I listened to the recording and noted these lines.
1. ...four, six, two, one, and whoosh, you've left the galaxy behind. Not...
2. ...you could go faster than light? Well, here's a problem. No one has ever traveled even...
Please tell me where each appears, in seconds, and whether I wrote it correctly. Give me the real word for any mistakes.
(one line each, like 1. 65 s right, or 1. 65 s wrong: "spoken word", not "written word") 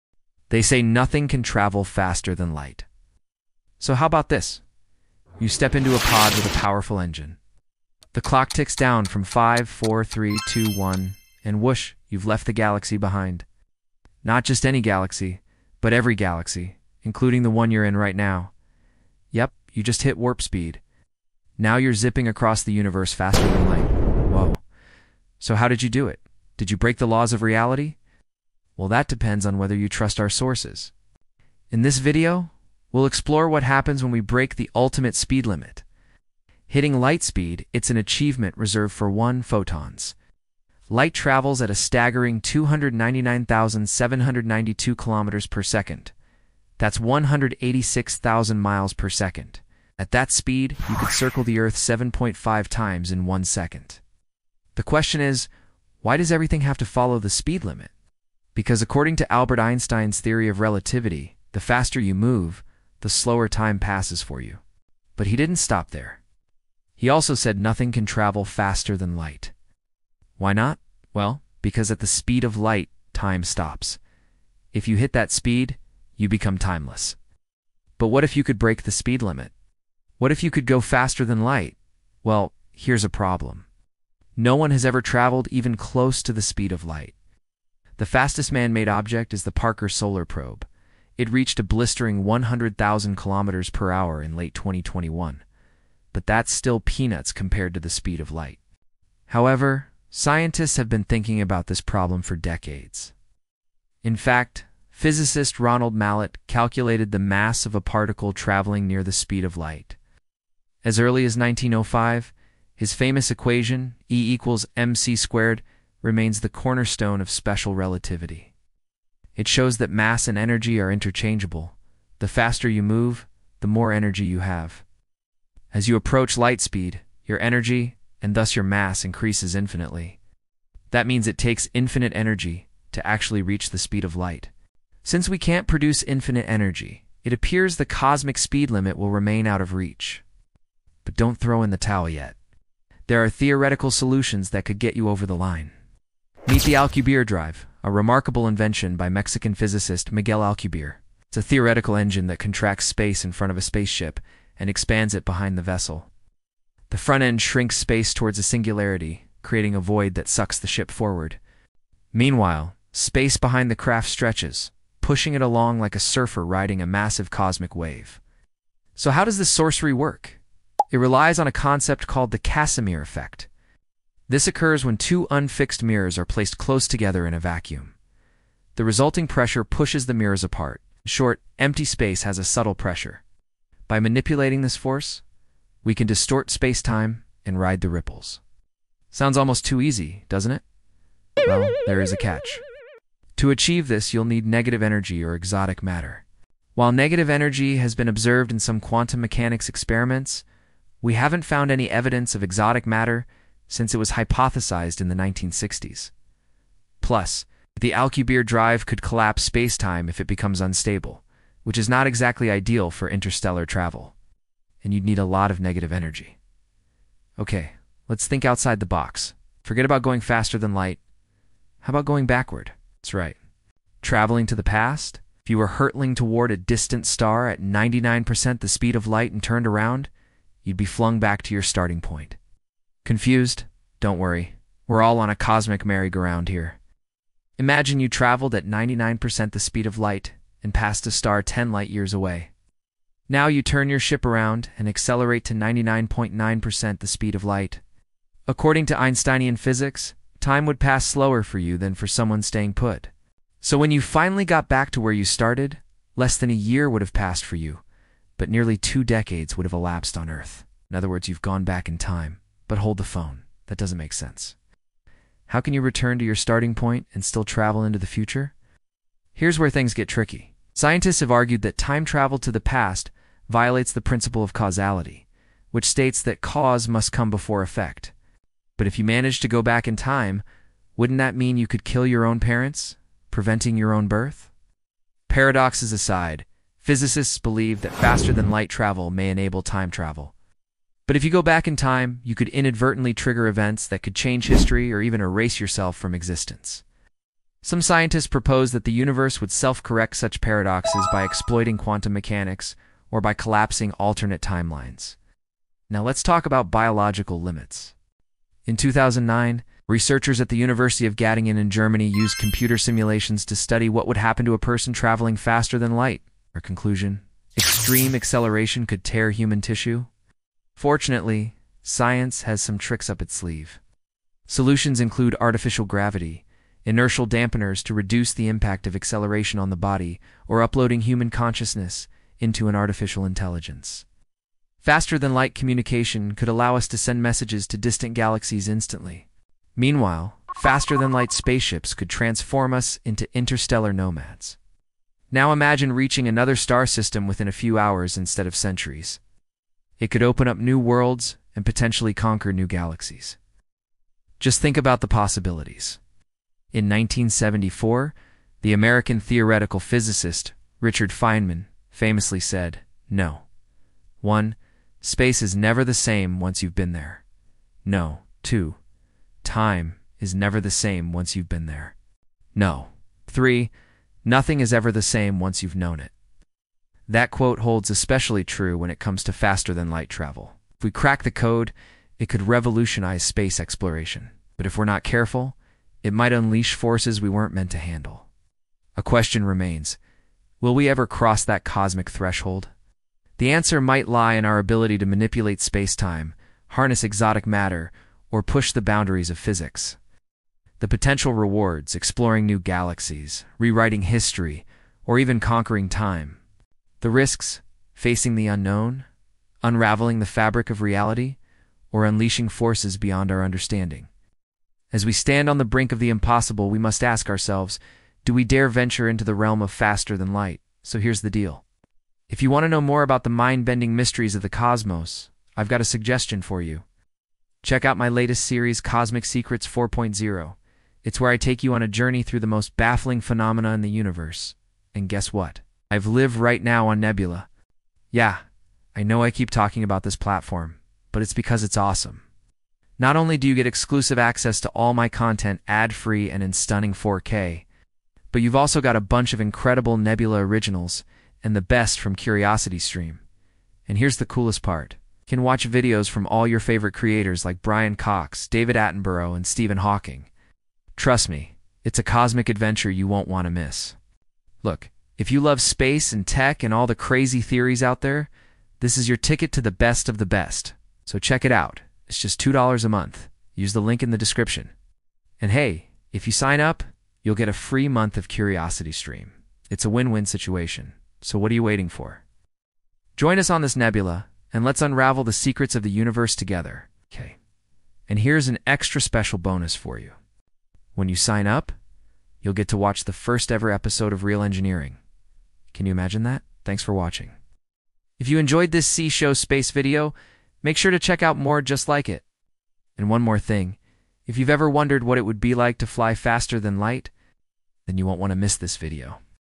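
1. 9 s wrong: "three", not "six"
2. 80 s right.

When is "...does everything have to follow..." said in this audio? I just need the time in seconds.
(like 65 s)
56 s.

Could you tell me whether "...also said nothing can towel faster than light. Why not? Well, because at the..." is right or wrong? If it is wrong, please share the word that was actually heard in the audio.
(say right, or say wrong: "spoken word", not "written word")
wrong: "travel", not "towel".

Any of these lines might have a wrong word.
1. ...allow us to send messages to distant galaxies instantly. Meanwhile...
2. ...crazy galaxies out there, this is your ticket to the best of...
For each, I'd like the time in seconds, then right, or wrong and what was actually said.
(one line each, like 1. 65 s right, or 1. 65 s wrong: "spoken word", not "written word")
1. 336 s right
2. 466 s wrong: "theories", not "galaxies".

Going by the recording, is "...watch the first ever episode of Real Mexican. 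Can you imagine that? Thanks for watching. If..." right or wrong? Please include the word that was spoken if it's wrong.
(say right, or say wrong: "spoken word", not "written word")
wrong: "Engineering", not "Mexican".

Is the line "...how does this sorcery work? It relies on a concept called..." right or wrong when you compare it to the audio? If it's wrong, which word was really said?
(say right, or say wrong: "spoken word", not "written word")
right.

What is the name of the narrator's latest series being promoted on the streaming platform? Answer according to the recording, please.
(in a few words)
Cosmic Secrets 4.0.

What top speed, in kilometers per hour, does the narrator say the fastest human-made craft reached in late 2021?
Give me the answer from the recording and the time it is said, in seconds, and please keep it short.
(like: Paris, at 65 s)
100,000 kilometers per hour, at 92 s.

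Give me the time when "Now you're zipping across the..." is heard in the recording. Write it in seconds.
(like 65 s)
21 s.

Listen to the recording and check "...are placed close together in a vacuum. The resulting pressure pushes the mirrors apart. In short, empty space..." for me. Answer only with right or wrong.
right.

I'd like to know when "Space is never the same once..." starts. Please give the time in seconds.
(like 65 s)
365 s.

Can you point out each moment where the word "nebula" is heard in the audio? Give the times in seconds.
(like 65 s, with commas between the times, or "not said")
437 s, 449 s, 483 s.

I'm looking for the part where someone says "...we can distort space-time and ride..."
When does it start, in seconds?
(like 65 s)
185 s.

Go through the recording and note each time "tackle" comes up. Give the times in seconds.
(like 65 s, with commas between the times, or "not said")
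not said.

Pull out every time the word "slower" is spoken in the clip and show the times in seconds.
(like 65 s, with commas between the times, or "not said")
63 s, 251 s.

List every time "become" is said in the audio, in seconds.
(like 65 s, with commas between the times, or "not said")
76 s, 210 s.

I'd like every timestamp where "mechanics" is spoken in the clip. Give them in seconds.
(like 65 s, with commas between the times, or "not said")
199 s, 302 s.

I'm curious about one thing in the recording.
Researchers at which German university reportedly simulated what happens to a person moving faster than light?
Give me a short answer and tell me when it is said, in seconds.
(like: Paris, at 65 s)
University of Göttingen, at 310 s.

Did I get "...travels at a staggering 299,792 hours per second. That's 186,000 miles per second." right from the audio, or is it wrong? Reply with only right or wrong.
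wrong.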